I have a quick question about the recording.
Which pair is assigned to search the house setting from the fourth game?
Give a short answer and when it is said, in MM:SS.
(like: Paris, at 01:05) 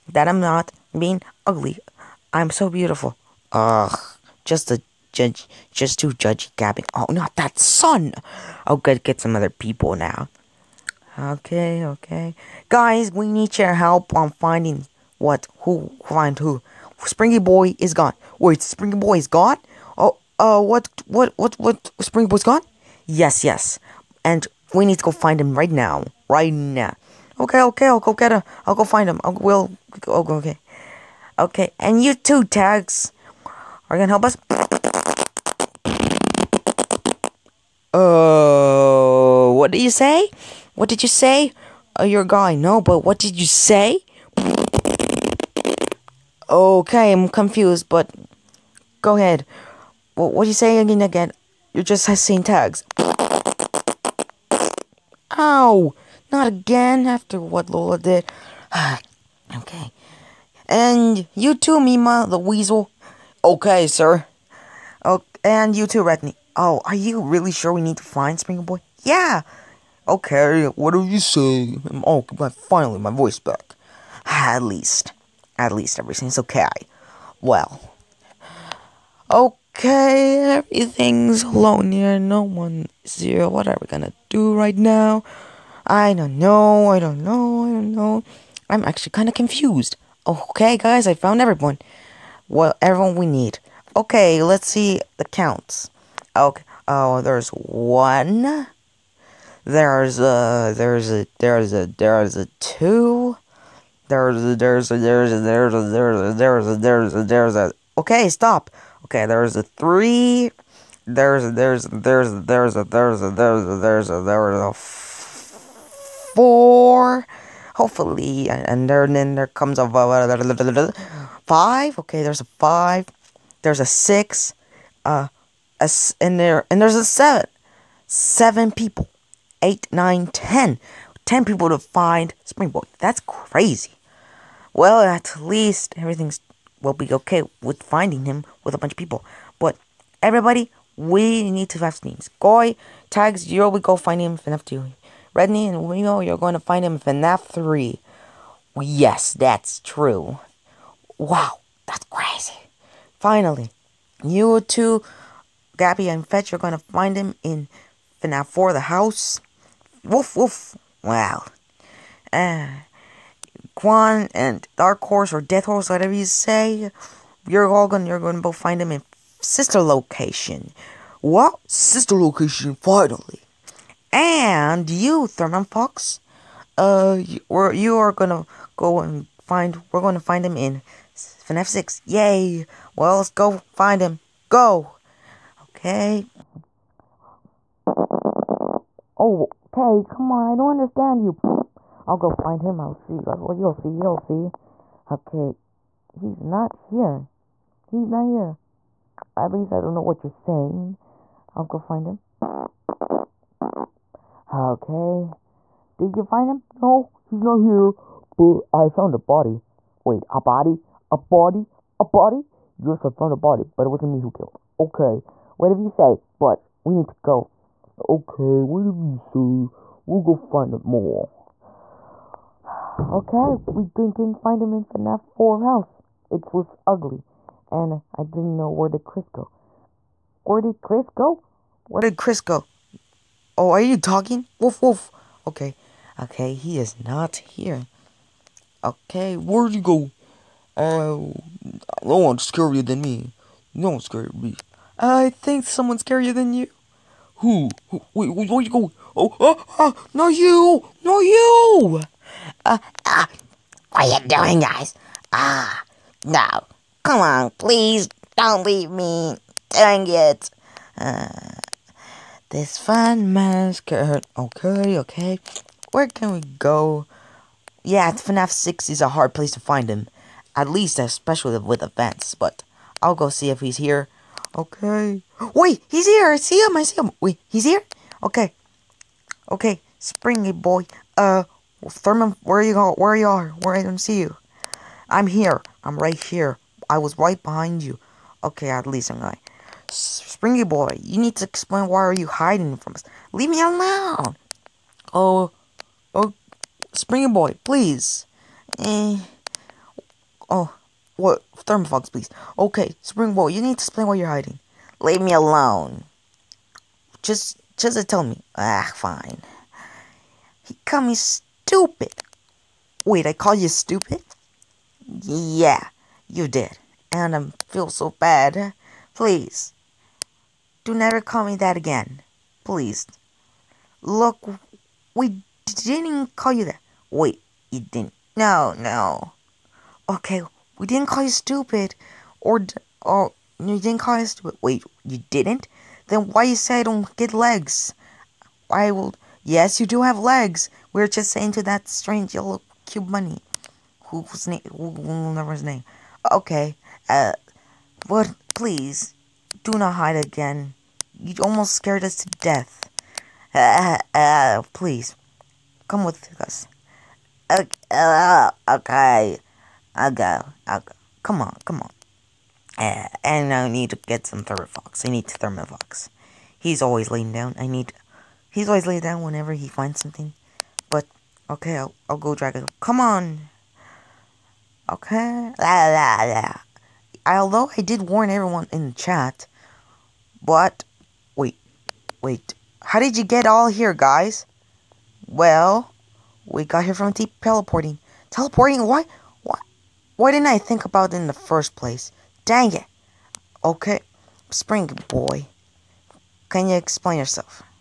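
Gabby and Fetch, at 02:35.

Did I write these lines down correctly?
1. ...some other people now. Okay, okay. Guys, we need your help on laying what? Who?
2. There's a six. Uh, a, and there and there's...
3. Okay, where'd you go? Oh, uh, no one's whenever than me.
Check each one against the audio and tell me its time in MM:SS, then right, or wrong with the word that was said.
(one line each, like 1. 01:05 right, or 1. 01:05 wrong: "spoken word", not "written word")
1. 00:09 wrong: "finding", not "laying"
2. 02:03 right
3. 03:58 wrong: "scarier", not "whenever".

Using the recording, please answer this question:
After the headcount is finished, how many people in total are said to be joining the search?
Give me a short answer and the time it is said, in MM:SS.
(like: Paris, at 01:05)
10, at 02:11.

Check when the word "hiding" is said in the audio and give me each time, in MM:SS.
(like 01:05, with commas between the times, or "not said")
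04:52, 05:04.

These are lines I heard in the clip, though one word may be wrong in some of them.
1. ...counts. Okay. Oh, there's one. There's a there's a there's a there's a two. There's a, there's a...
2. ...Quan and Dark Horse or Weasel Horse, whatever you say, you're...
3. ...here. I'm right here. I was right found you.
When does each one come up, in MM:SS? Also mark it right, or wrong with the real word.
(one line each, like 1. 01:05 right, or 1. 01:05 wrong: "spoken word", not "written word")
1. 01:35 right
2. 02:43 wrong: "Death", not "Weasel"
3. 04:45 wrong: "behind", not "found".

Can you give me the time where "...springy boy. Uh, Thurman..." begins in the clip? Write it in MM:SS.
04:39.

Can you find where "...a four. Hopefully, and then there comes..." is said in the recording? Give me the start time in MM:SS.
01:54.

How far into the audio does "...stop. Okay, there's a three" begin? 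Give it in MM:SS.
01:48.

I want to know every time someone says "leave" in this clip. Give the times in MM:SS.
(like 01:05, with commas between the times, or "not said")
04:18, 04:53, 05:04.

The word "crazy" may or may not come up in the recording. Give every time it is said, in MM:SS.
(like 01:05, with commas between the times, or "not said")
02:13, 02:32.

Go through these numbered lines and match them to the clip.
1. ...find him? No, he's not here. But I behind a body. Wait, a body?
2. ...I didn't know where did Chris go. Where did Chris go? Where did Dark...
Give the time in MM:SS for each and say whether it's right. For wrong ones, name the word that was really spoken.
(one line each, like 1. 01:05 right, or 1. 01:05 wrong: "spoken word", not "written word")
1. 03:26 wrong: "found", not "behind"
2. 03:48 wrong: "Chris", not "Dark".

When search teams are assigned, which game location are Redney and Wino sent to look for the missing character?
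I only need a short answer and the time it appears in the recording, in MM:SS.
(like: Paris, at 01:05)
FNAF 3, at 02:26.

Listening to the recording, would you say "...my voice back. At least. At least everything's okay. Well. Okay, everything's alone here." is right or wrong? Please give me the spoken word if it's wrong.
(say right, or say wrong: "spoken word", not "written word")
right.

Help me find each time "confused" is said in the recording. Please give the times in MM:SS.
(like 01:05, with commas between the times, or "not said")
00:47, 01:29.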